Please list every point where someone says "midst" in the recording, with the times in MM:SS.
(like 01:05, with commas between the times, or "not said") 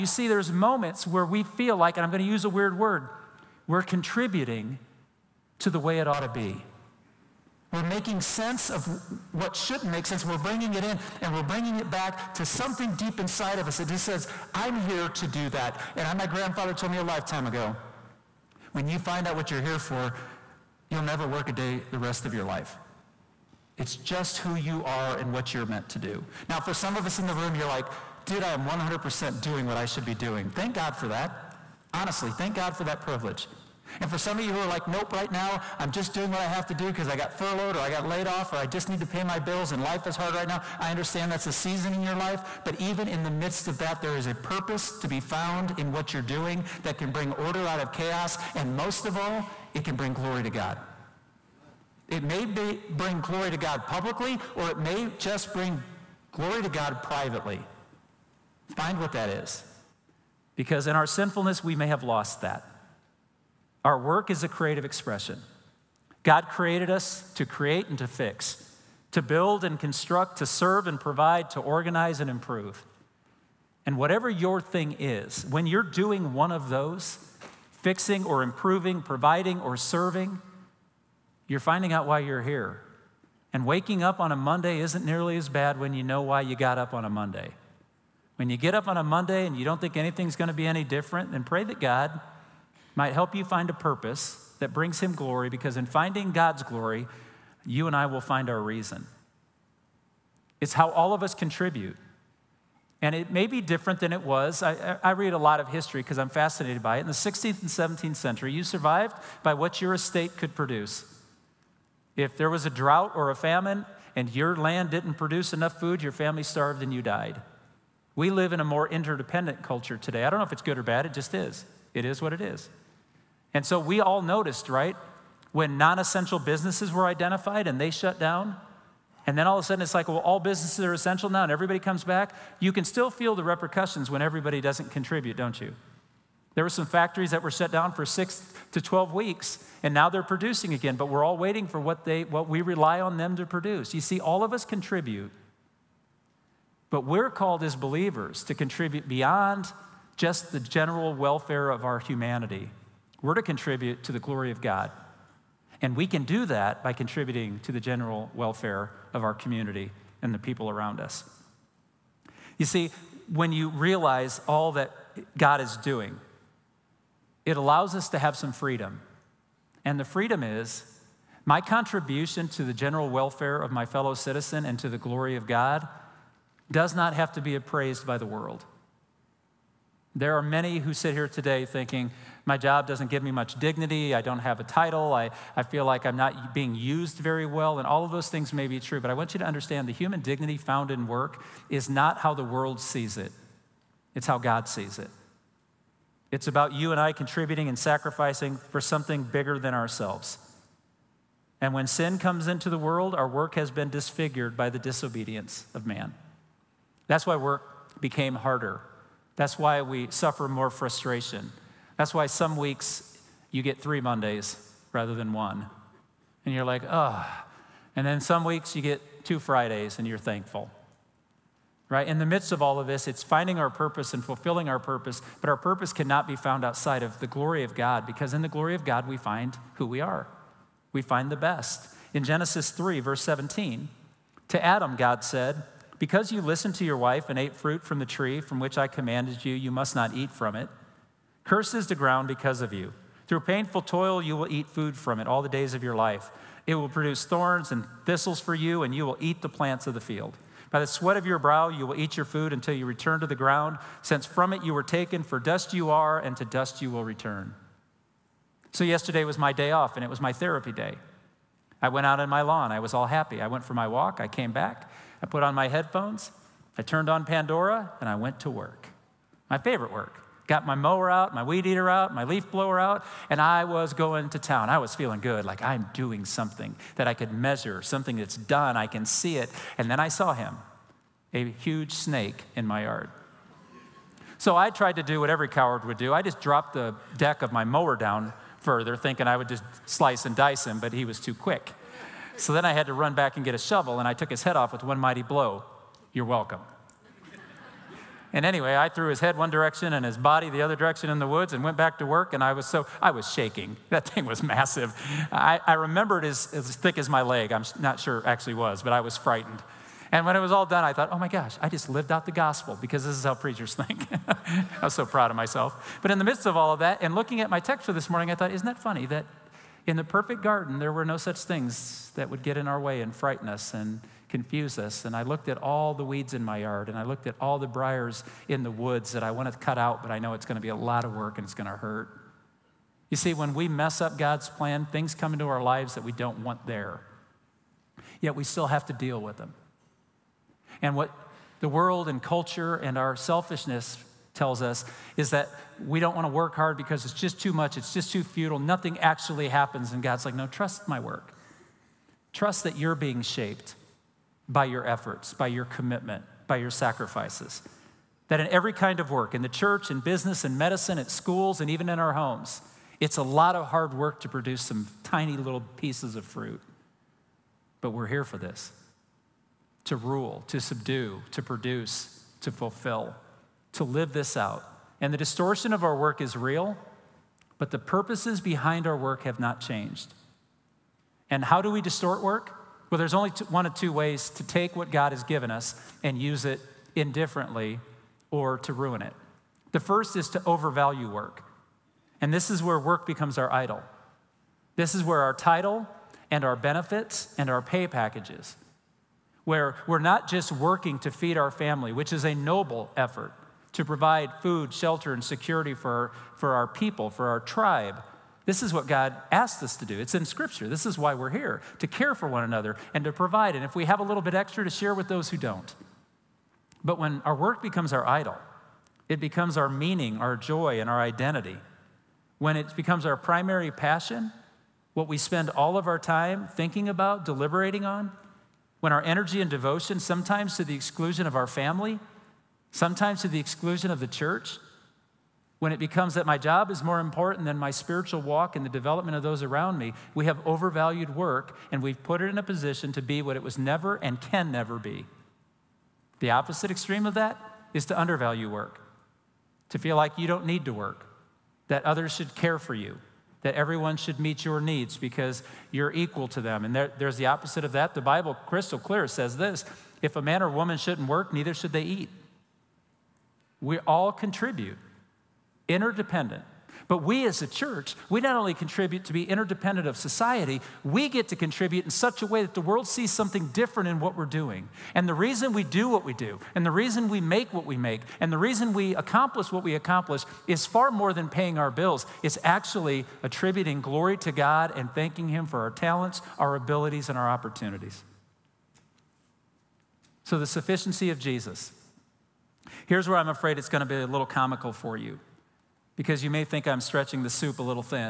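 00:43, 03:42, 05:16.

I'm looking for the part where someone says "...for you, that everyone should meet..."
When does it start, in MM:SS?
07:32.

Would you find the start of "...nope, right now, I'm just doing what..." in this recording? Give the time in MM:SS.
00:34.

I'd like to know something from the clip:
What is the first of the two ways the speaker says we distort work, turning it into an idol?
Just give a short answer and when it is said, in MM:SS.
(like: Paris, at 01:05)
Overvalue work, at 06:30.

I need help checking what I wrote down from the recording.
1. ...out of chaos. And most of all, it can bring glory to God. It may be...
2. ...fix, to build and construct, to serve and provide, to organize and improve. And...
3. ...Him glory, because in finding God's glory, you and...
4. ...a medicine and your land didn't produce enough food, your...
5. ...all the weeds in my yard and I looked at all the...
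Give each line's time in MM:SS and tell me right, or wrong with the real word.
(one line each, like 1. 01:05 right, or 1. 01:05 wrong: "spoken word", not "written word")
1. 00:47 right
2. 01:08 right
3. 01:34 right
4. 01:53 wrong: "famine", not "medicine"
5. 05:25 right.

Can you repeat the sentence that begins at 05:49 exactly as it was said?
And God's like, no, trust my work.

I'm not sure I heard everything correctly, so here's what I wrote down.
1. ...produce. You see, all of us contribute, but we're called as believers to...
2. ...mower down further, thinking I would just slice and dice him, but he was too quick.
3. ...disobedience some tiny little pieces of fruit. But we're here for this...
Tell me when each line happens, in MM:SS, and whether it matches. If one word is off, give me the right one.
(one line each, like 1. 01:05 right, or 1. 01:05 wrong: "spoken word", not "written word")
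1. 02:23 right
2. 04:47 right
3. 06:04 wrong: "produce", not "disobedience".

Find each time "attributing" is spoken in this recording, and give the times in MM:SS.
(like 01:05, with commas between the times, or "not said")
08:03.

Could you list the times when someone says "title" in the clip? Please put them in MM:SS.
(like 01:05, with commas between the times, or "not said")
03:04, 06:35.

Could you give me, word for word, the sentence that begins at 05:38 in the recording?
Yet we still have to deal with them.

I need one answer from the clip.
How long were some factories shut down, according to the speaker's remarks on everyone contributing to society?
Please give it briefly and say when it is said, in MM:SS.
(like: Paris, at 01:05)
6 to 12 weeks, at 02:18.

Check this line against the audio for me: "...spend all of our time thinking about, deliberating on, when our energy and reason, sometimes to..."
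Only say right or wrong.
wrong.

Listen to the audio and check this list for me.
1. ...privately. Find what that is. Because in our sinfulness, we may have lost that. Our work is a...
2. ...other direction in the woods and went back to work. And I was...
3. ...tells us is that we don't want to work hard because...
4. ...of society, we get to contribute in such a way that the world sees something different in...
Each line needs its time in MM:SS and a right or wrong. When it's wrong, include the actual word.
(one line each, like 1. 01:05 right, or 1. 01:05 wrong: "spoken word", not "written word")
1. 00:57 right
2. 05:00 right
3. 05:44 right
4. 07:49 right.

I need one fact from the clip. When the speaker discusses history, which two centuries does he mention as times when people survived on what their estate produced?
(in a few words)
16th and 17th century.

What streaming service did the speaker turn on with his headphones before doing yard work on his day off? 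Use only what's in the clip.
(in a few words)
Pandora.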